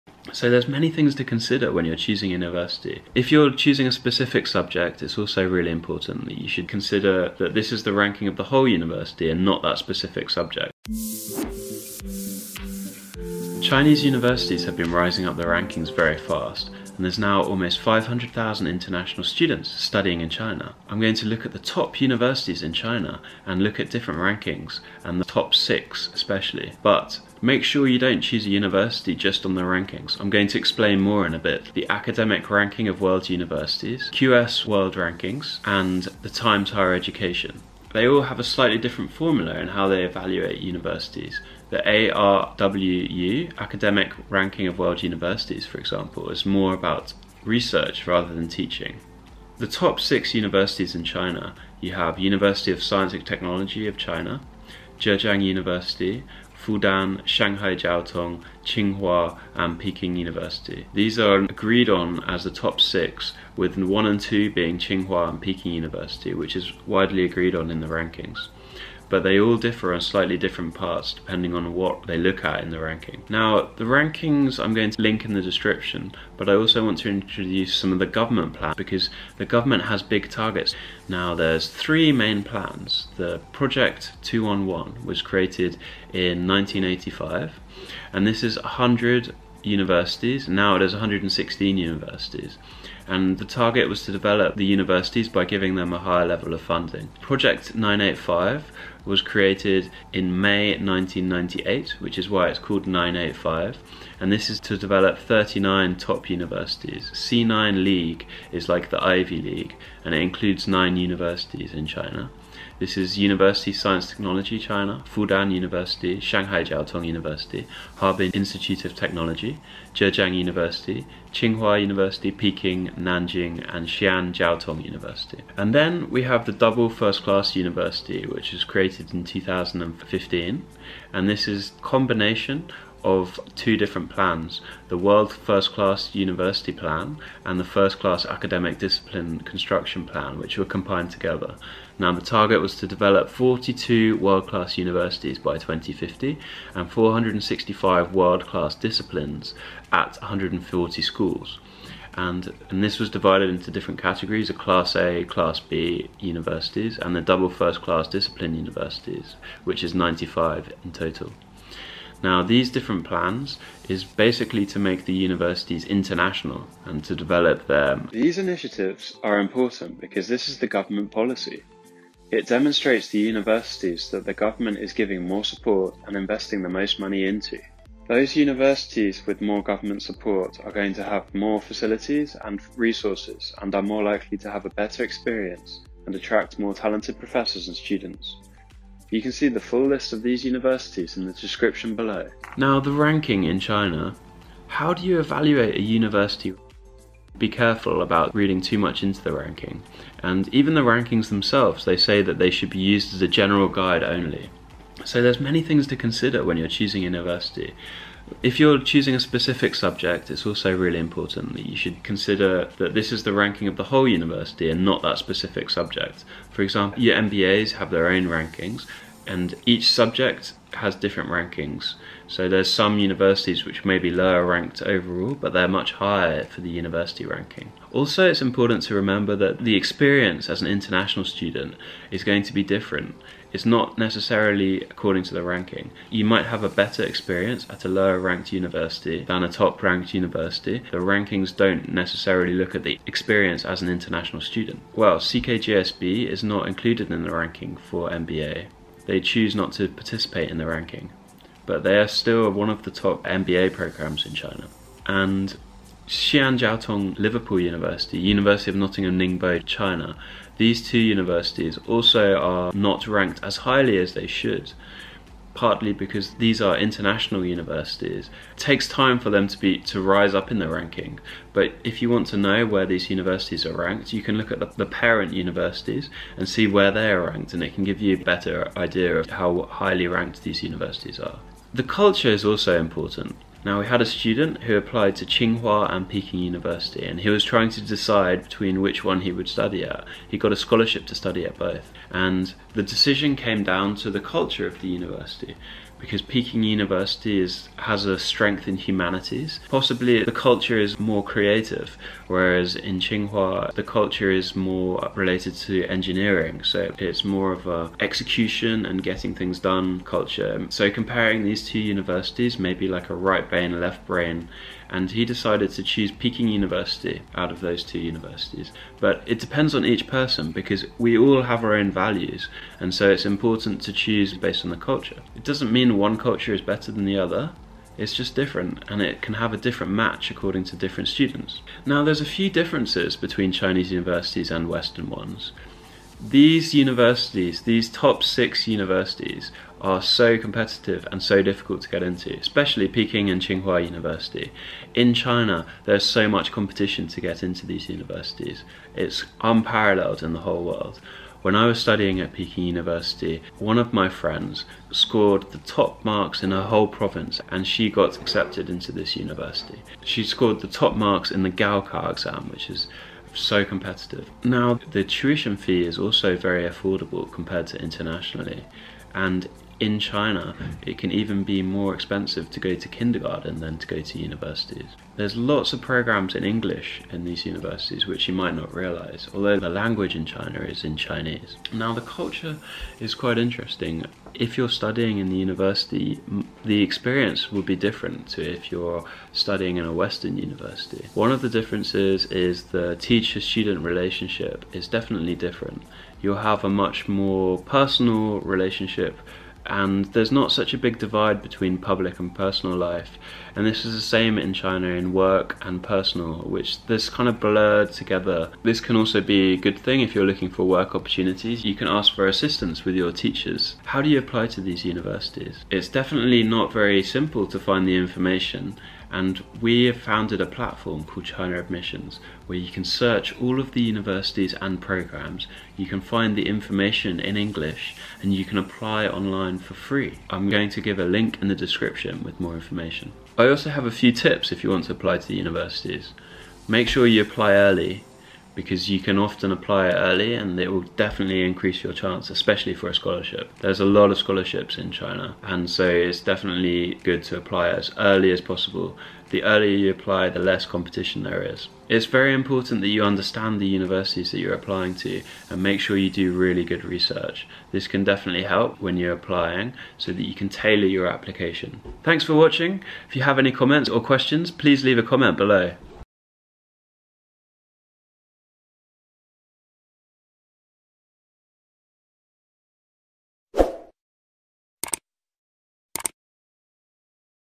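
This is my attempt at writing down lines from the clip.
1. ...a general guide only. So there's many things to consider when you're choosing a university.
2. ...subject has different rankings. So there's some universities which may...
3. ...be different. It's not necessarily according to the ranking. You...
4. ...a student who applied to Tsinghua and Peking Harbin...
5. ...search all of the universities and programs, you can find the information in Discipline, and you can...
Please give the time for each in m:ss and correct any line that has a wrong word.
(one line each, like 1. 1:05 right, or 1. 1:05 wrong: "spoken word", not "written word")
1. 3:23 right
2. 3:39 right
3. 3:52 right
4. 4:44 wrong: "University", not "Harbin"
5. 7:02 wrong: "English", not "Discipline".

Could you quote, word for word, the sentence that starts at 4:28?
It takes time for them to be to rise up in the ranking.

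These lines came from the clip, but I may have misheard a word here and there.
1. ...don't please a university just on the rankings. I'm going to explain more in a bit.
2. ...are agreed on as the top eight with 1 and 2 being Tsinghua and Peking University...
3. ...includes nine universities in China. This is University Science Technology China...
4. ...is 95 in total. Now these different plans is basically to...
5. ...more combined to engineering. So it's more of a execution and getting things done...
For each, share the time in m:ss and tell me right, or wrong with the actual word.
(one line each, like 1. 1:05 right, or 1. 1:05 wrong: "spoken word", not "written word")
1. 0:27 wrong: "choose", not "please"
2. 1:01 wrong: "six", not "eight"
3. 1:50 right
4. 2:39 right
5. 5:04 wrong: "related", not "combined".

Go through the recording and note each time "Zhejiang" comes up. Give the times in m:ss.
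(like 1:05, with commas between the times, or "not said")
0:54, 1:59.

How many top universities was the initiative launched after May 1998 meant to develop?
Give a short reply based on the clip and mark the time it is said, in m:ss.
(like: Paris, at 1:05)
39, at 1:45.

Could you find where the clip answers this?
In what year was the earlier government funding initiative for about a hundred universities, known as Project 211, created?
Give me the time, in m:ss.
1:26.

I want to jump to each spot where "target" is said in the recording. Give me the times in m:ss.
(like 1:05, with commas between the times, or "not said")
1:20, 1:33, 2:22.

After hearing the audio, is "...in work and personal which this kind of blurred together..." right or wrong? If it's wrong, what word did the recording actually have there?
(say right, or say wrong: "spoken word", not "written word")
right.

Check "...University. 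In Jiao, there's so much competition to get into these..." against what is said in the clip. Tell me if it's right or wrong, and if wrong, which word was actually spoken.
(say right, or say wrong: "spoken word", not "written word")
wrong: "China", not "Jiao".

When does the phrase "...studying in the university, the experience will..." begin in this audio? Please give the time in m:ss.
6:24.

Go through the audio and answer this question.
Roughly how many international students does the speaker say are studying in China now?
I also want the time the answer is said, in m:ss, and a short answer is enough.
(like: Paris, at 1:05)
almost 500,000, at 0:17.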